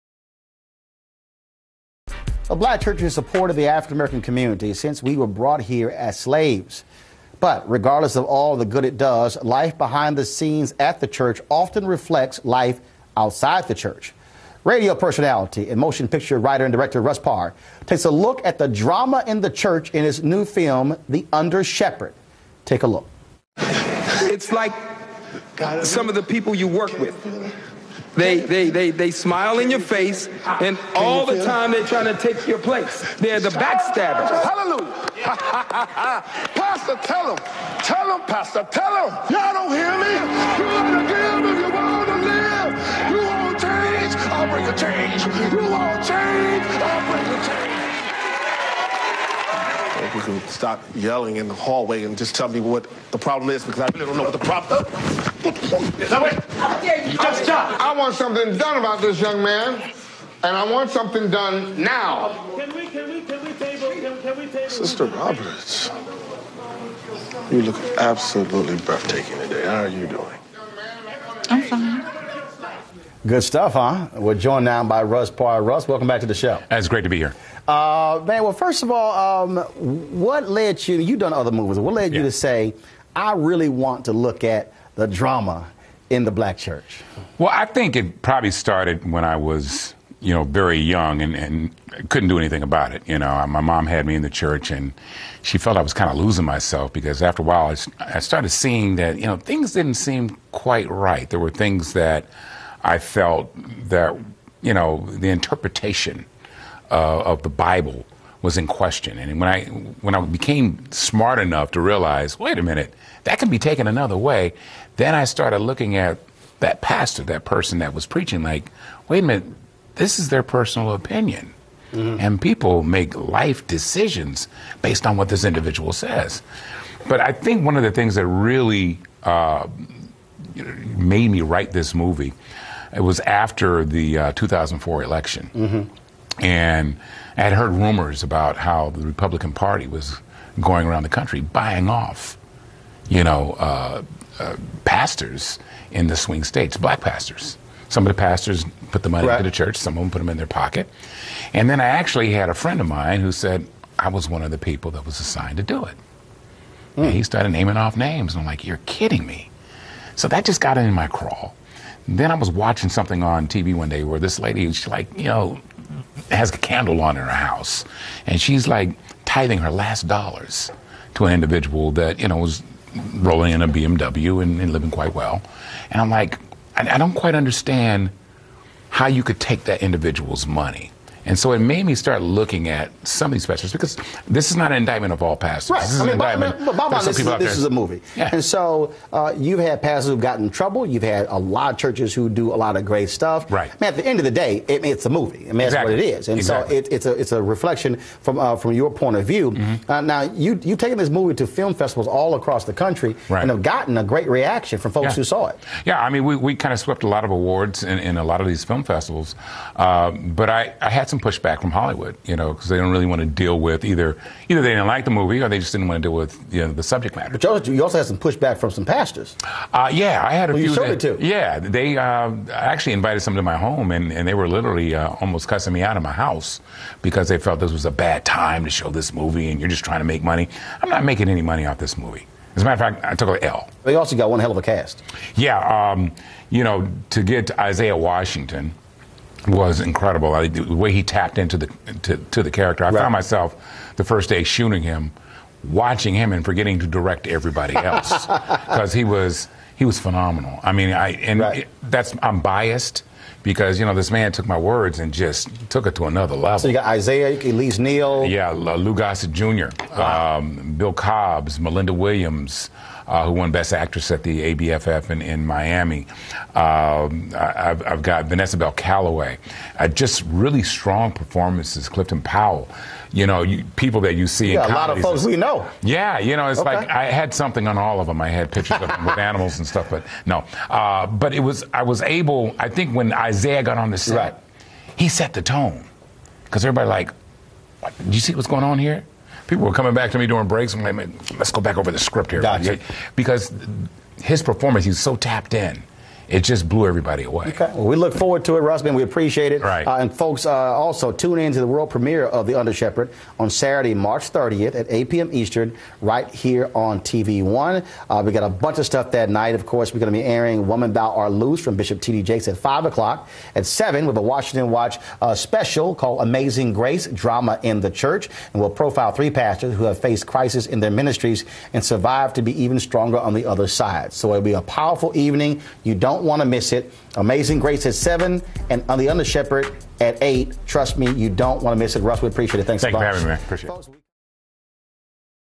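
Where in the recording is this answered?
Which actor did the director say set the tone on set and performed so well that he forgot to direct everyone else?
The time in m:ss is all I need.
3:57.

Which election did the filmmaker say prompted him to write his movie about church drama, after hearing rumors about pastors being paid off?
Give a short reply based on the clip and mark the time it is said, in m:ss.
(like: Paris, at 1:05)
2004 election, at 2:14.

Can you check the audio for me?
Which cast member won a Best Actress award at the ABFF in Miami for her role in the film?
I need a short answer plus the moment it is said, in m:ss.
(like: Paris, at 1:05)
Melinda Williams, at 4:21.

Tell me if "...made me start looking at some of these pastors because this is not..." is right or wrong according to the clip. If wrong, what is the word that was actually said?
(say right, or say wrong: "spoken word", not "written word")
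right.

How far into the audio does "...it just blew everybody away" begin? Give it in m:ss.
4:56.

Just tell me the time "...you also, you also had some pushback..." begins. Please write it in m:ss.
3:37.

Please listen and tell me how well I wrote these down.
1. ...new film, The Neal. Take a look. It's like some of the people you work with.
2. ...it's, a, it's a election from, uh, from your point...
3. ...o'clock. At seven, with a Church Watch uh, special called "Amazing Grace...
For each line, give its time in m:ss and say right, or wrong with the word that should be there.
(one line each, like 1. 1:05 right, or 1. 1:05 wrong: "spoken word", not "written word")
1. 0:20 wrong: "Undershepherd", not "Neal"
2. 3:16 wrong: "reflection", not "election"
3. 5:12 wrong: "Washington", not "Church".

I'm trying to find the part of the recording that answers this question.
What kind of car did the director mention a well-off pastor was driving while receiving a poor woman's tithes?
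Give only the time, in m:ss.
2:53.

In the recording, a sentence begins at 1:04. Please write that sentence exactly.
Sister Roberts, you look absolutely breathtaking today.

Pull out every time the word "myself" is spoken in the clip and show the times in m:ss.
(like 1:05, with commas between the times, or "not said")
1:36, 4:03.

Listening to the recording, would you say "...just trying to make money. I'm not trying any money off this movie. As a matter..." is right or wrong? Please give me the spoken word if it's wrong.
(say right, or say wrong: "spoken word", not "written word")
wrong: "making", not "trying".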